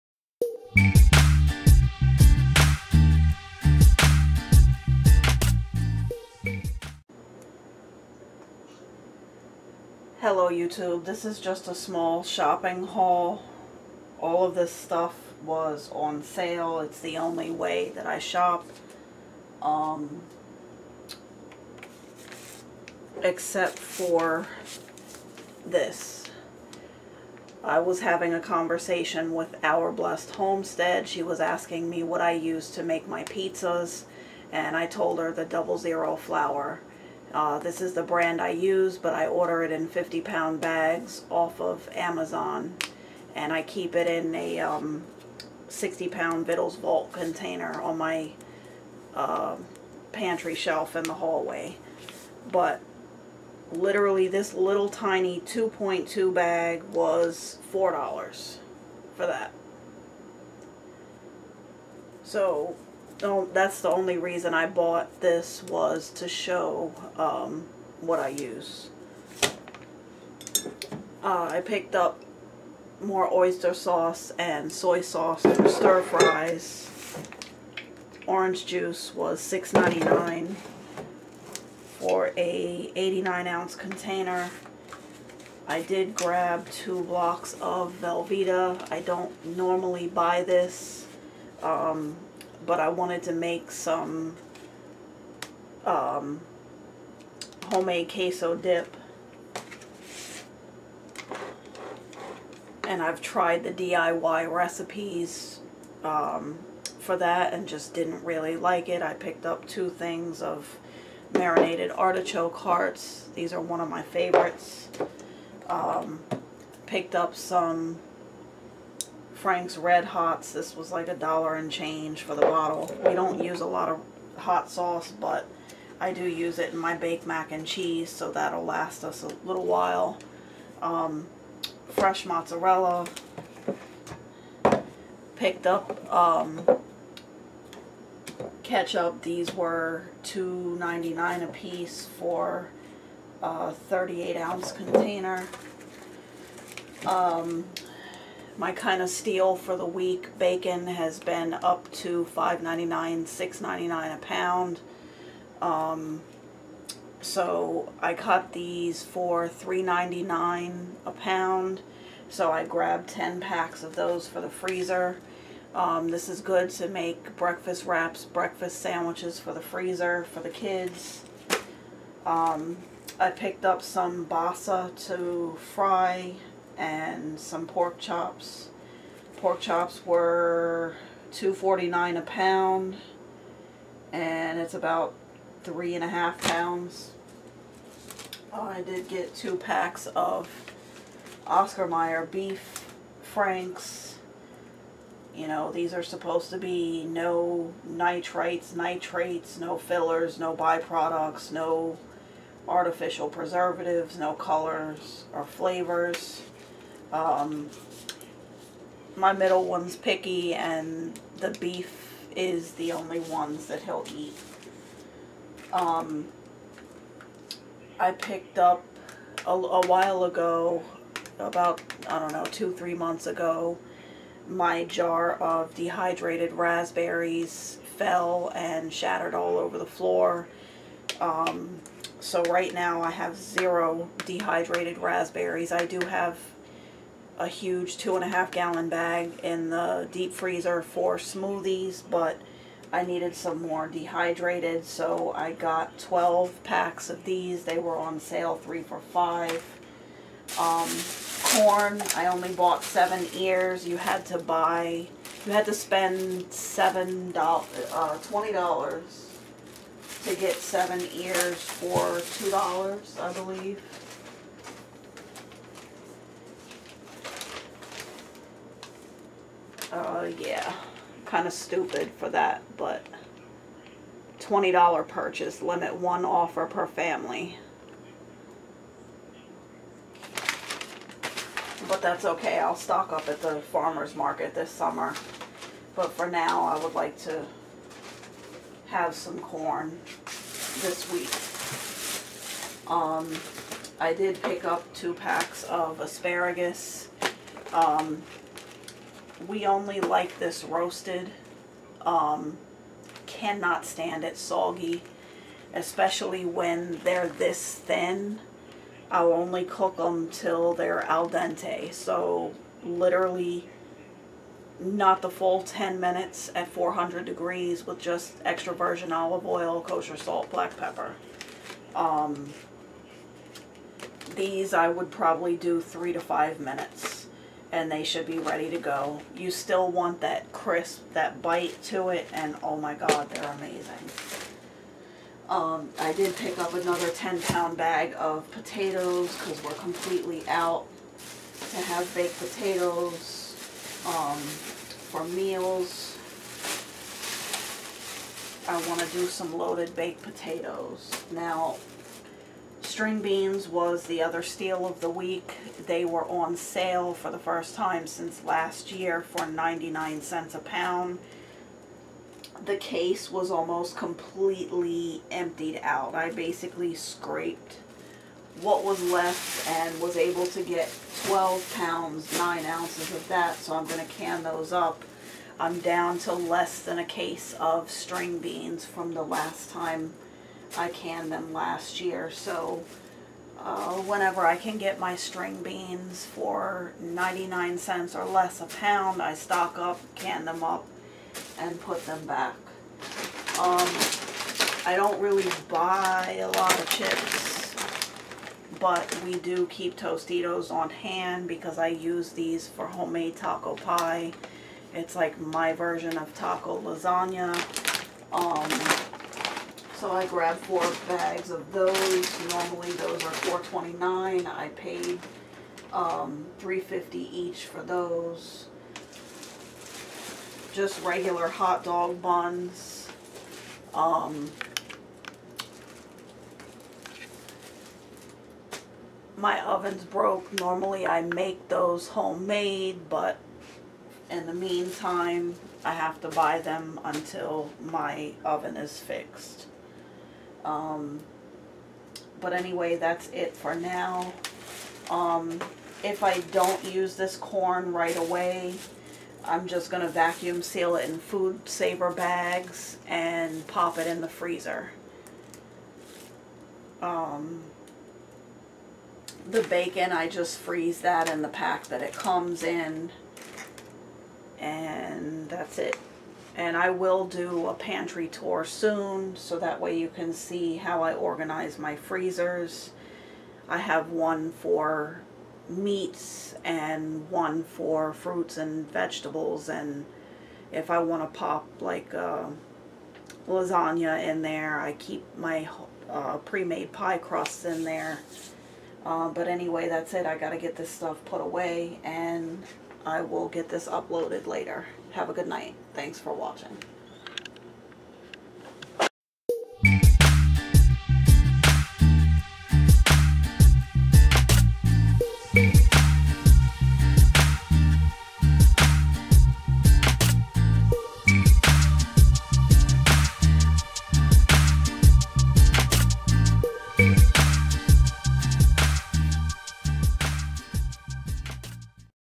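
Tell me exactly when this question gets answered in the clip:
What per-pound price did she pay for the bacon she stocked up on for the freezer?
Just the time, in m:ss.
2:39.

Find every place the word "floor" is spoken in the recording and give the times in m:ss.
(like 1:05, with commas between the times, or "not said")
3:49.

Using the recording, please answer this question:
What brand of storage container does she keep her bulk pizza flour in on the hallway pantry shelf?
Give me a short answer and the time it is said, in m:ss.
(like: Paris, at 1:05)
Vittles Vault, at 0:46.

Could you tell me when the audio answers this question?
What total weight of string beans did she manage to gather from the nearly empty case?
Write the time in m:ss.
6:11.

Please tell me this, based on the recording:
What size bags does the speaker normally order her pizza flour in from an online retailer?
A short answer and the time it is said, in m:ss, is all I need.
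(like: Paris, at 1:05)
50-pound, at 0:39.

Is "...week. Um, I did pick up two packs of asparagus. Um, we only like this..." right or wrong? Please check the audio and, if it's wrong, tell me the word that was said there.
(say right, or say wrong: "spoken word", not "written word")
right.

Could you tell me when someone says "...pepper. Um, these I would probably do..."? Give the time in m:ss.
5:20.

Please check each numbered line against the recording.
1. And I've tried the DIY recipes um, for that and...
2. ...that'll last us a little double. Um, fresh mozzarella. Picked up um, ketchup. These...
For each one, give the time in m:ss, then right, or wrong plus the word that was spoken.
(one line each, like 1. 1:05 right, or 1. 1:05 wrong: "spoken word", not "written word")
1. 1:42 right
2. 2:08 wrong: "while", not "double".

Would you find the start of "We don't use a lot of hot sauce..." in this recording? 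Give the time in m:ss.
2:03.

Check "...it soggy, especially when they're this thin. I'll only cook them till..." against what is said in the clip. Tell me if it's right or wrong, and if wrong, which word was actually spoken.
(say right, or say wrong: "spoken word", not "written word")
right.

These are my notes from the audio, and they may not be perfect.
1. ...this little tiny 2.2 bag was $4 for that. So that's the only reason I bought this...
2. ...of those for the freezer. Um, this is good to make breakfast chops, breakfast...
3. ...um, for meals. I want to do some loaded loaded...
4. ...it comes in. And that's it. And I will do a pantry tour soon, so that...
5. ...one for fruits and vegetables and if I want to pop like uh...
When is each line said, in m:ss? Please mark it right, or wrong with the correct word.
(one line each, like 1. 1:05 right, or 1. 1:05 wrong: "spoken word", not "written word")
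1. 0:54 right
2. 2:43 wrong: "wraps", not "chops"
3. 5:44 wrong: "baked", not "loaded"
4. 7:42 right
5. 7:57 right.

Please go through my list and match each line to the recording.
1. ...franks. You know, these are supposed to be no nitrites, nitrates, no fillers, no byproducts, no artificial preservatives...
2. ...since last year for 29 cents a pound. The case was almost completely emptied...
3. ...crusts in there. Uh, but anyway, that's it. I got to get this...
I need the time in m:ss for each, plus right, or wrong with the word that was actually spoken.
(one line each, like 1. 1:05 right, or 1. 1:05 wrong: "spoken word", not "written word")
1. 3:13 right
2. 5:58 wrong: "99", not "29"
3. 8:07 right.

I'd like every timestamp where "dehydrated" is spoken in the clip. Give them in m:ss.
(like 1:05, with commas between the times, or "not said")
3:45, 3:54, 4:03.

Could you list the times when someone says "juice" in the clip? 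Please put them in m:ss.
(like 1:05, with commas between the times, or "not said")
1:18.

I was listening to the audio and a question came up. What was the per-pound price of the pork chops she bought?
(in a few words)
$2.49.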